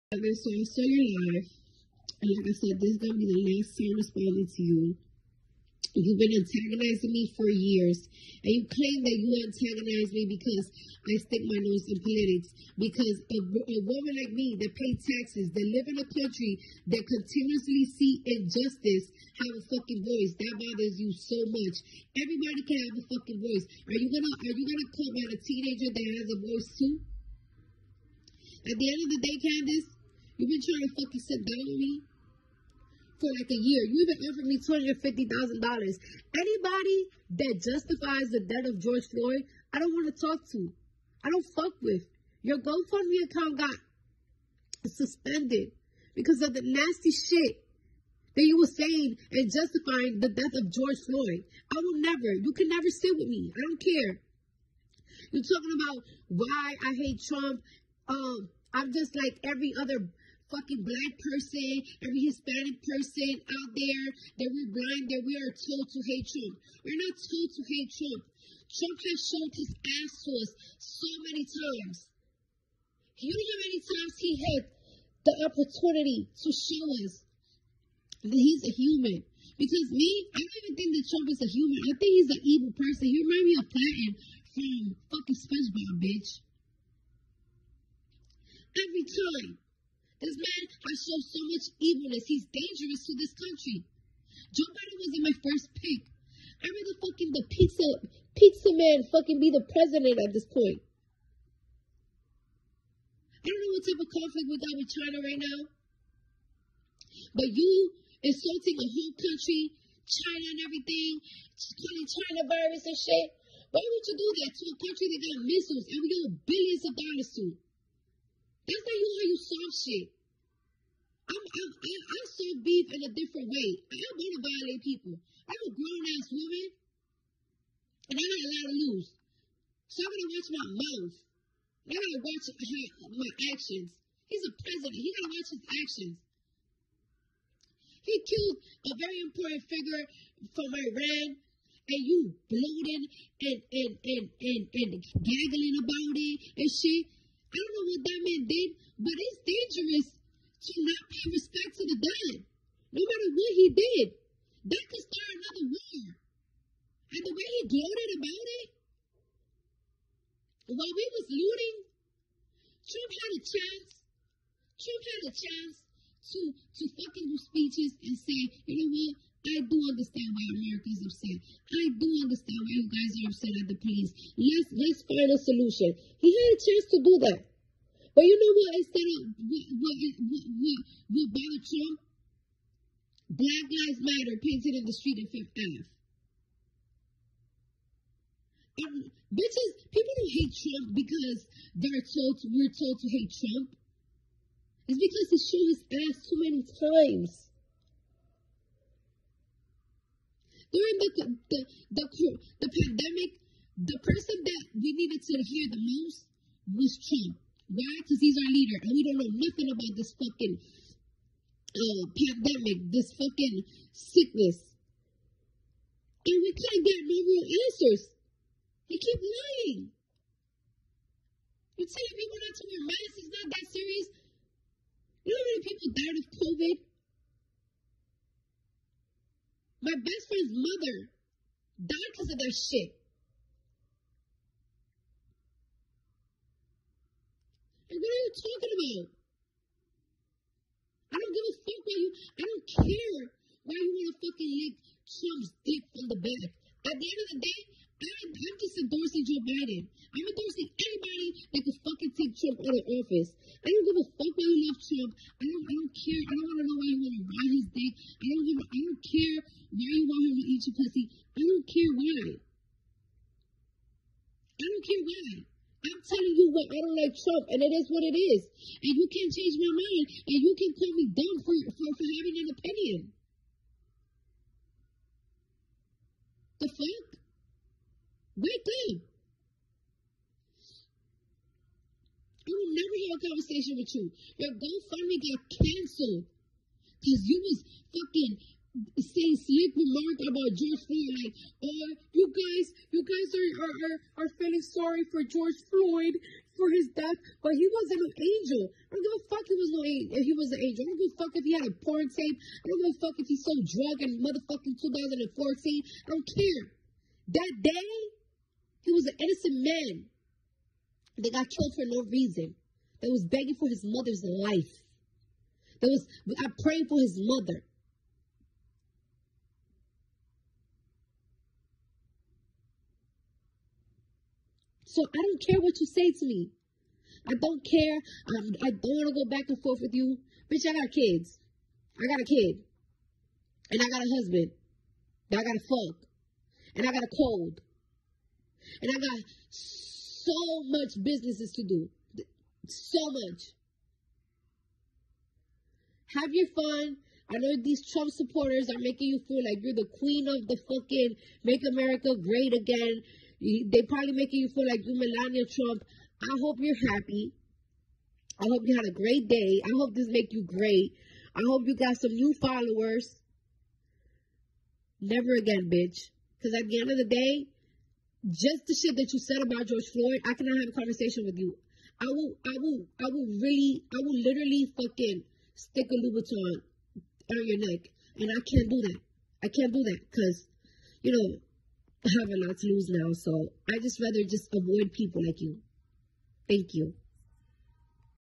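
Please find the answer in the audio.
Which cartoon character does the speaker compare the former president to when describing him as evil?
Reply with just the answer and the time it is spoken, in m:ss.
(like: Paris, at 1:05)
Plankton, at 1:23.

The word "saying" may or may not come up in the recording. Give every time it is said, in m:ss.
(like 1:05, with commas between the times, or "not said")
0:48, 4:49.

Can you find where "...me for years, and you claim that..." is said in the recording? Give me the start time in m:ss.
0:07.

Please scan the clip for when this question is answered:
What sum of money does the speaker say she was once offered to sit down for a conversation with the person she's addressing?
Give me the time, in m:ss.
0:34.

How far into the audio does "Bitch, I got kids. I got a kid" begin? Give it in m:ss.
5:30.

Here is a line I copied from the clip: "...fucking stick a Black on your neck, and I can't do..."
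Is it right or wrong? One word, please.
wrong.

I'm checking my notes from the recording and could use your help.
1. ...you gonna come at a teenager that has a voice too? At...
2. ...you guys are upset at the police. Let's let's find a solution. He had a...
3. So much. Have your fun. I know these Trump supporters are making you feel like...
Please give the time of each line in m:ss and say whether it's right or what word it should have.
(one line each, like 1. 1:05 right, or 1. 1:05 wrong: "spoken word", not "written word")
1. 0:24 right
2. 2:52 right
3. 5:42 right.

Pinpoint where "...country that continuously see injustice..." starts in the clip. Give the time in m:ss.
0:16.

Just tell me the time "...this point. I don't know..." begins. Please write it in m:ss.
1:40.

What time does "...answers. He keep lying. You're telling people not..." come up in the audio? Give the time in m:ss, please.
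3:37.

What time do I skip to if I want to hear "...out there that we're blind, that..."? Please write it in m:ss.
1:03.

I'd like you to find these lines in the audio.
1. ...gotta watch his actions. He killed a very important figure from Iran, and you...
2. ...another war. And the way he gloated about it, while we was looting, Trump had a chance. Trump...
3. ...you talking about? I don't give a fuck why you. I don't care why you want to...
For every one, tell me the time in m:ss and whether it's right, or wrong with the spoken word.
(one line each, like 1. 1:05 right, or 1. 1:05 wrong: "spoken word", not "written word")
1. 2:15 right
2. 2:35 right
3. 3:58 right.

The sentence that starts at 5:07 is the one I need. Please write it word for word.
That day, he was an innocent man that got killed for no reason.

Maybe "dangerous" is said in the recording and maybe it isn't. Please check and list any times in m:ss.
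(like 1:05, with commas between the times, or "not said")
1:32, 2:29.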